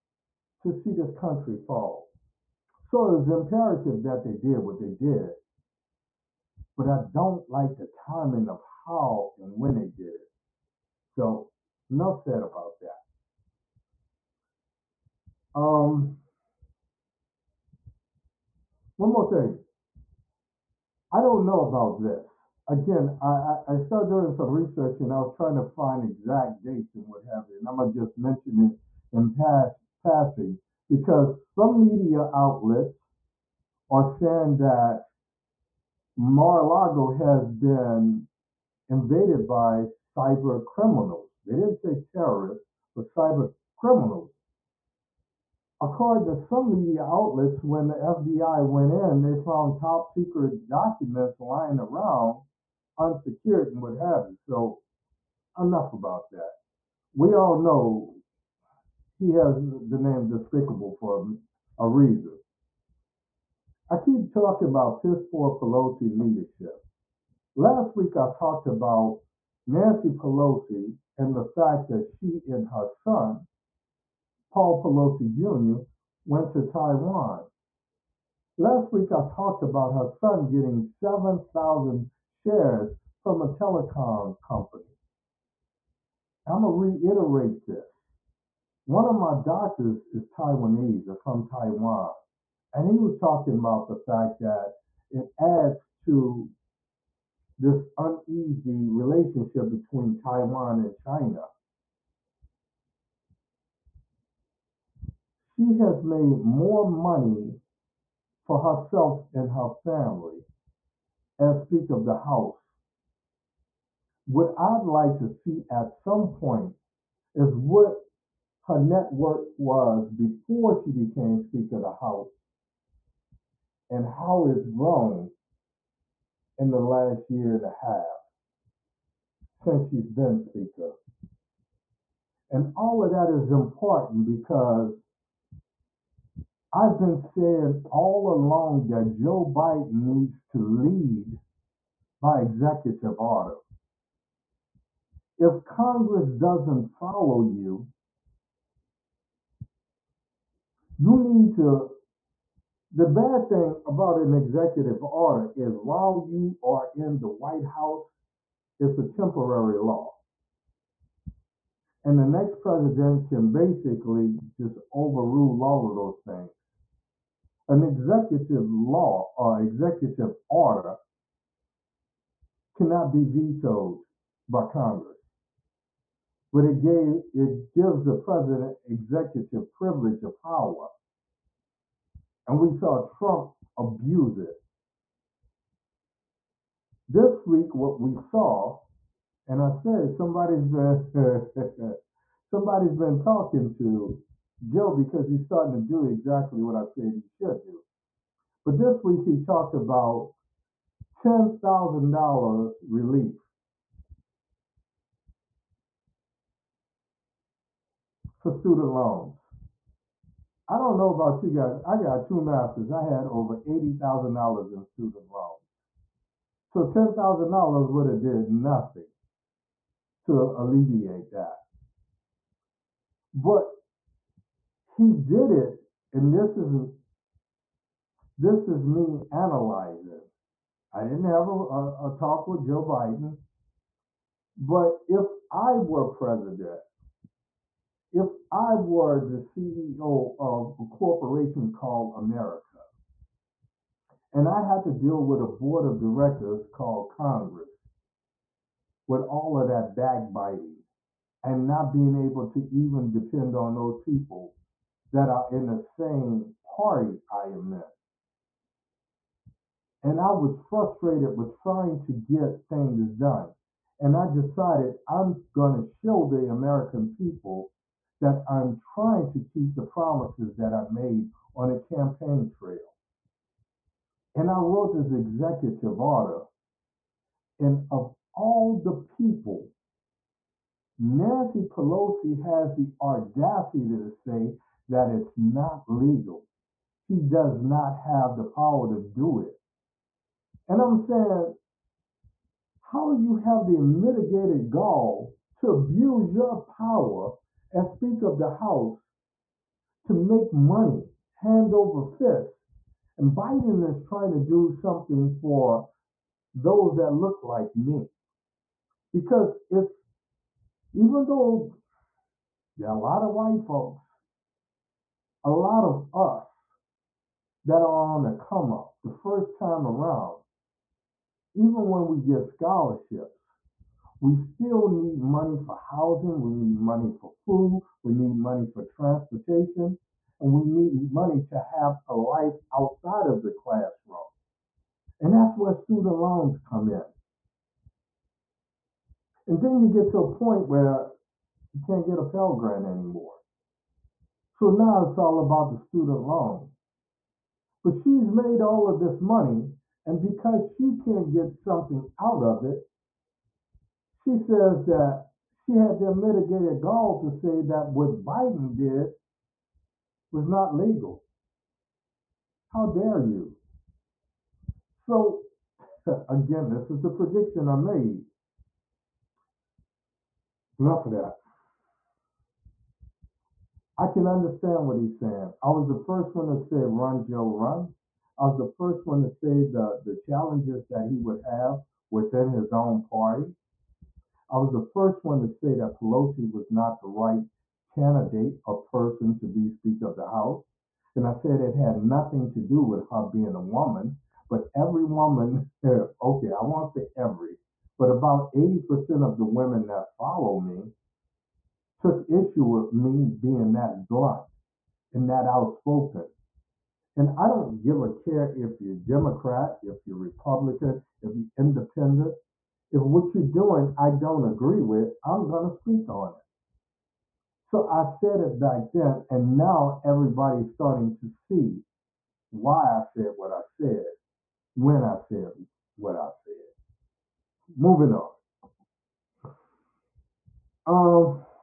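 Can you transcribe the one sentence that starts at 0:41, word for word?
They didn't say terrorists, but cyber criminals.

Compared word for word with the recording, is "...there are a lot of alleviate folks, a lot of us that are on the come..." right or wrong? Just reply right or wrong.
wrong.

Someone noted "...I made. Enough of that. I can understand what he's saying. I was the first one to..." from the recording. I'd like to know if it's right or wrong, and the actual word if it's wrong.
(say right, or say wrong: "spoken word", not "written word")
right.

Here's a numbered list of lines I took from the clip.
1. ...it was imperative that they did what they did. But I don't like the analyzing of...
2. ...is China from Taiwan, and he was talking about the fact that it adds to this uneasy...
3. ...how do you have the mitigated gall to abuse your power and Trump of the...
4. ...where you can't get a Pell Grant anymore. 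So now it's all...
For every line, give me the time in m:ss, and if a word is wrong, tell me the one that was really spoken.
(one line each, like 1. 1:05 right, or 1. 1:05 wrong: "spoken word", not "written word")
1. 0:03 wrong: "timing", not "analyzing"
2. 1:30 wrong: "Taiwanese", not "China"
3. 4:52 wrong: "Speaker", not "Trump"
4. 5:40 right.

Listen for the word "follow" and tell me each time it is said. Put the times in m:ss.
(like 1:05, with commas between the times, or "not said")
2:26, 6:40.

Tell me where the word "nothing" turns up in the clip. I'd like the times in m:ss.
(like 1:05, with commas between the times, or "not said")
3:38, 6:31.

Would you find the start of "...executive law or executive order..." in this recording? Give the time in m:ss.
2:47.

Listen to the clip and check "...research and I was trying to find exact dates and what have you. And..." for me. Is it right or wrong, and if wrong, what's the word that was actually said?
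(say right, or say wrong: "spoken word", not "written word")
right.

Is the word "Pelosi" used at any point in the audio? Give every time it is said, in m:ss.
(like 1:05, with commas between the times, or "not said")
1:05, 1:10, 1:14, 4:41, 6:25.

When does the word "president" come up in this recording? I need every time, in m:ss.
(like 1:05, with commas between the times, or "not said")
2:42, 2:58, 3:56.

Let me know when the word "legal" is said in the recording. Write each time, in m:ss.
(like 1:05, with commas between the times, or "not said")
4:45, 6:00.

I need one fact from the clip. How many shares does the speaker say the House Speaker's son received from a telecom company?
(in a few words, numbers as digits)
7,000.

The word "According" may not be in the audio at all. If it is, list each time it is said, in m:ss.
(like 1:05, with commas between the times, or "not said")
0:45.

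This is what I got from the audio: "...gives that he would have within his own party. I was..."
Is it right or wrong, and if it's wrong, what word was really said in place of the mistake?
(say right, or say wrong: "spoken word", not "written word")
wrong: "challenges", not "gives".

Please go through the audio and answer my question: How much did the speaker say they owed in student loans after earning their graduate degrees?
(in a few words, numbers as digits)
$80,000.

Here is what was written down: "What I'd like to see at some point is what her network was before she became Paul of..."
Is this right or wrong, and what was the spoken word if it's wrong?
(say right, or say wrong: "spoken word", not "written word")
wrong: "Speaker", not "Paul".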